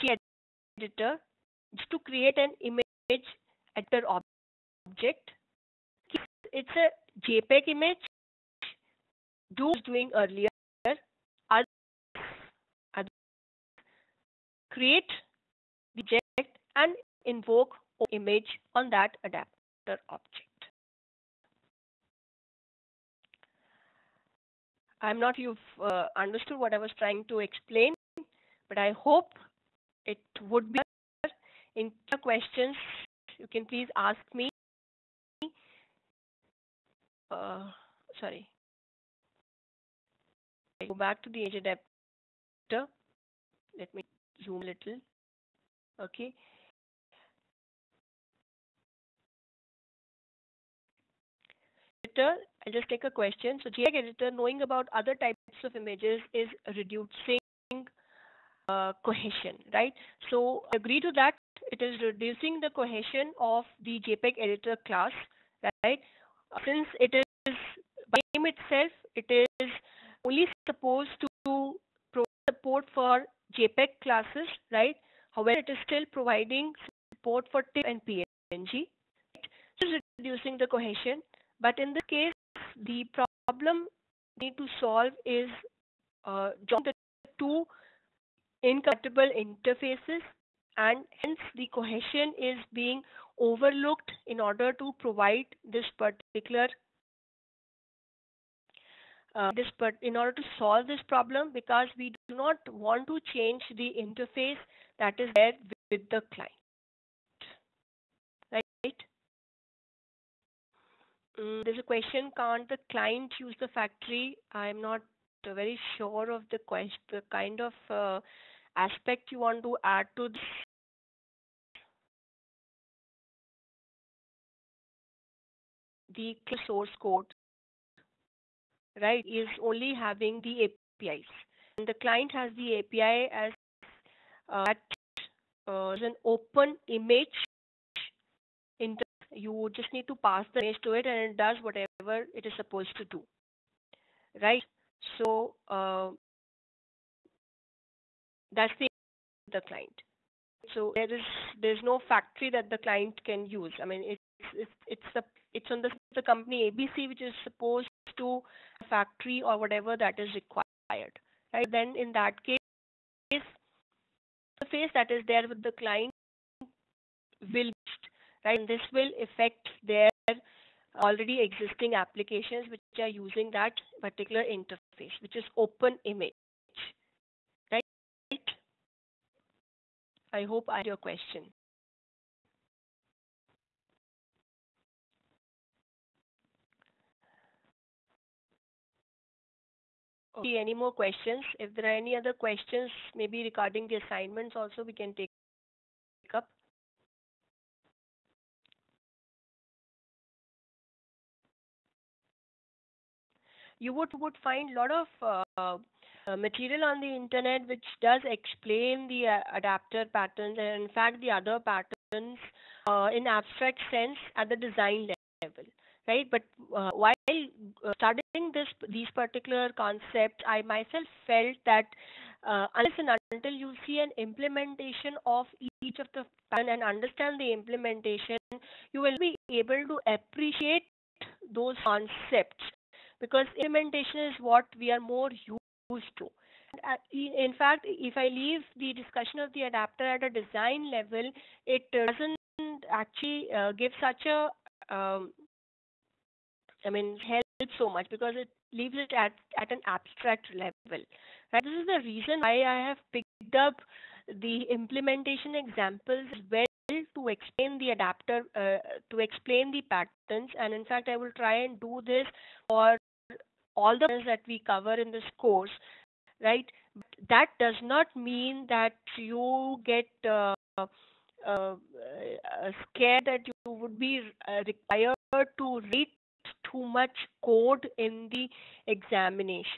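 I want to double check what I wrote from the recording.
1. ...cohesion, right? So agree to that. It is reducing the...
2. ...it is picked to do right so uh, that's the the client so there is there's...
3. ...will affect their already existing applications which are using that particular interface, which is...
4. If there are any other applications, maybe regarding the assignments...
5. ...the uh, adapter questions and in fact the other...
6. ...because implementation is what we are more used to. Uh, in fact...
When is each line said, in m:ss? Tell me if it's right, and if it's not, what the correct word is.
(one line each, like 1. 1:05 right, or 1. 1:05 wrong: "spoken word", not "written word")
1. 0:59 right
2. 2:22 wrong: "supposed", not "picked"
3. 2:48 right
4. 3:11 wrong: "questions", not "applications"
5. 3:29 wrong: "patterns", not "questions"
6. 3:53 right.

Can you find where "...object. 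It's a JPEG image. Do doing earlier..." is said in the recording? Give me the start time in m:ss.
0:04.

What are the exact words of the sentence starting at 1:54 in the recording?
I'm not very sure of the question, the kind of uh, aspect you want to add to this.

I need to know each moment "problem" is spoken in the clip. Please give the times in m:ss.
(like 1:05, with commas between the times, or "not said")
1:23, 1:41.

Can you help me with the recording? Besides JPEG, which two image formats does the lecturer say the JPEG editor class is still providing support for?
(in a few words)
TIFF and PNG.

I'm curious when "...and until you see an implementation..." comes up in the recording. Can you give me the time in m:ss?
3:42.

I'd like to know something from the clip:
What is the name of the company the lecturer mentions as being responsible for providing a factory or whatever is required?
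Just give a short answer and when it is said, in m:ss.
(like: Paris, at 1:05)
ABC, at 2:36.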